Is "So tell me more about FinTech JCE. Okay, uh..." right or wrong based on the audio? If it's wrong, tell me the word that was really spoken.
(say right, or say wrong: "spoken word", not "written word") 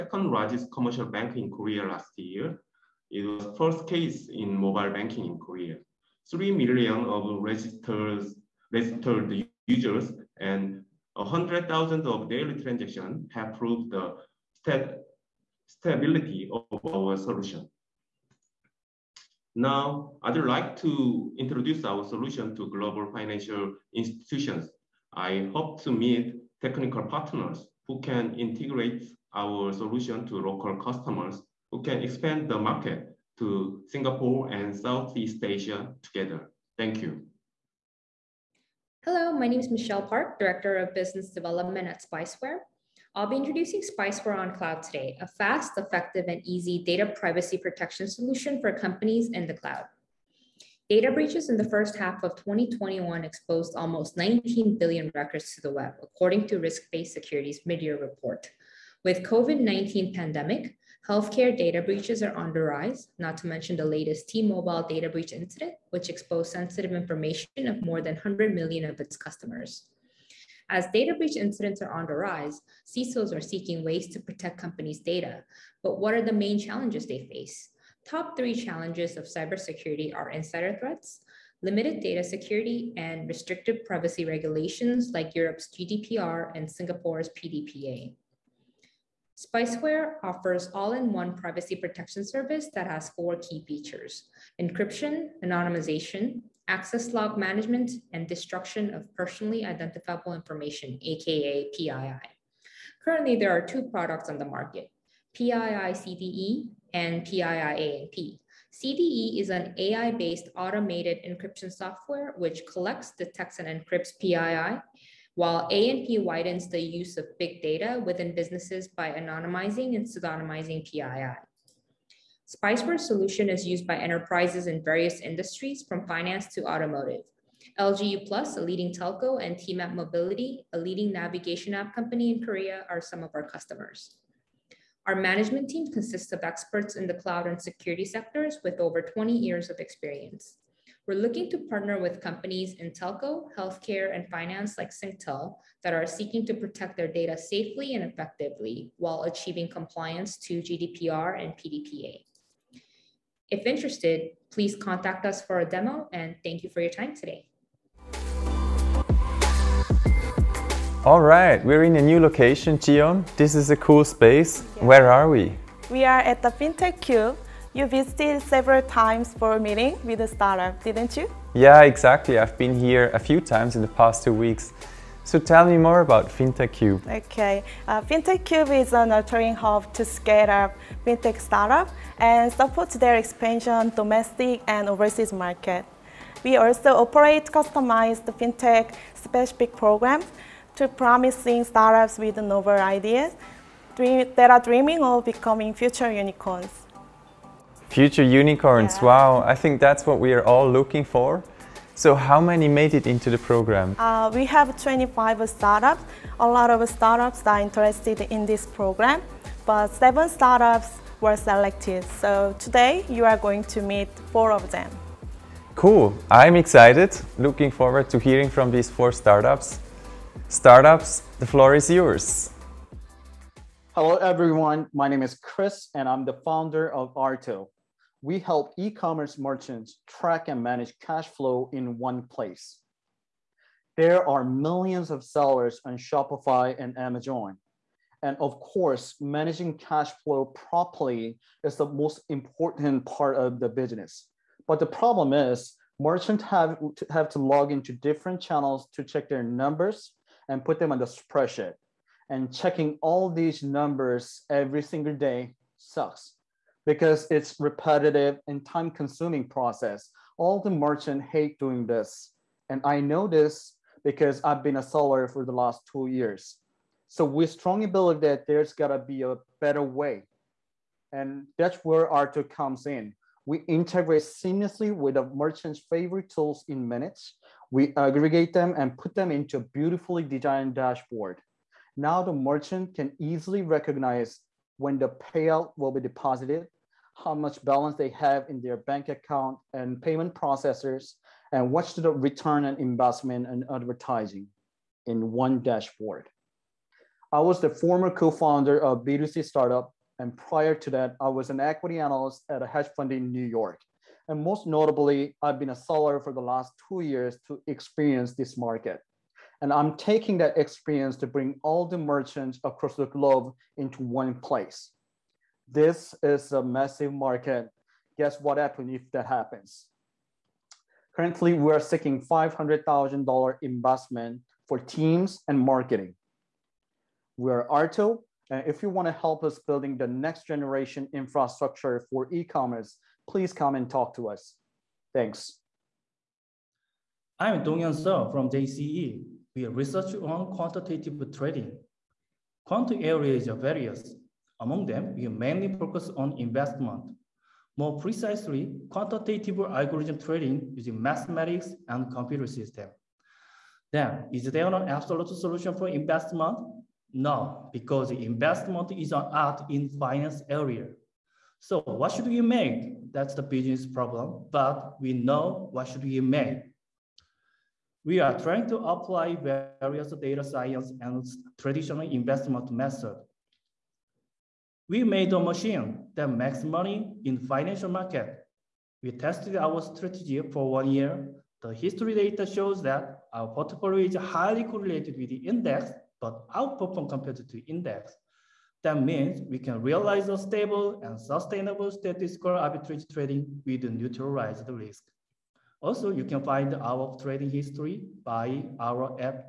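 wrong: "Cube", not "JCE".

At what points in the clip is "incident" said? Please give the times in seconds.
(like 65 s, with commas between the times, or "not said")
65 s, 71 s.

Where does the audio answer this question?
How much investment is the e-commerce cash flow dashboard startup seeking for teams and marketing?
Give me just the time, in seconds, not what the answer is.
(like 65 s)
322 s.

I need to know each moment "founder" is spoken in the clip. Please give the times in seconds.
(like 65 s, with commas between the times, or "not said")
226 s, 298 s.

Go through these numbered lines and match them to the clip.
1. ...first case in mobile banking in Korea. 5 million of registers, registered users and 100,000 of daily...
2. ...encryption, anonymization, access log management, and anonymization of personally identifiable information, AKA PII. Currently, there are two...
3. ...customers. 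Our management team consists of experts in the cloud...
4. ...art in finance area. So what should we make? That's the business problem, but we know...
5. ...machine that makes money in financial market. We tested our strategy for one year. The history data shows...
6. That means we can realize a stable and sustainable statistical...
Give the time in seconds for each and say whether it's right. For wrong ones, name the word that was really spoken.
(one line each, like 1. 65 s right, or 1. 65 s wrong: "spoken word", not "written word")
1. 3 s wrong: "3", not "5"
2. 94 s wrong: "destruction", not "anonymization"
3. 133 s right
4. 359 s right
5. 375 s right
6. 388 s right.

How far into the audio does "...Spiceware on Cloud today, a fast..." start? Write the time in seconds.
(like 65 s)
43 s.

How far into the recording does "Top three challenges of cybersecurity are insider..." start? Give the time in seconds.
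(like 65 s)
78 s.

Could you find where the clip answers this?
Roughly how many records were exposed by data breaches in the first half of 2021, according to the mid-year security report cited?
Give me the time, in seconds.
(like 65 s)
54 s.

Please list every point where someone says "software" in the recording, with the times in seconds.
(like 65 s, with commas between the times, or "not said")
111 s.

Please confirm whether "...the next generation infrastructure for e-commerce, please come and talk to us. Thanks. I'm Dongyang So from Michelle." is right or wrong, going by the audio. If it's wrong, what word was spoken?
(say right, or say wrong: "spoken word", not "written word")
wrong: "JCE", not "Michelle".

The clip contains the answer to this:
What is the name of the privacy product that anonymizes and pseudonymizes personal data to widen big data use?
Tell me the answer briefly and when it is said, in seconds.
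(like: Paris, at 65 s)
PII ANP, at 107 s.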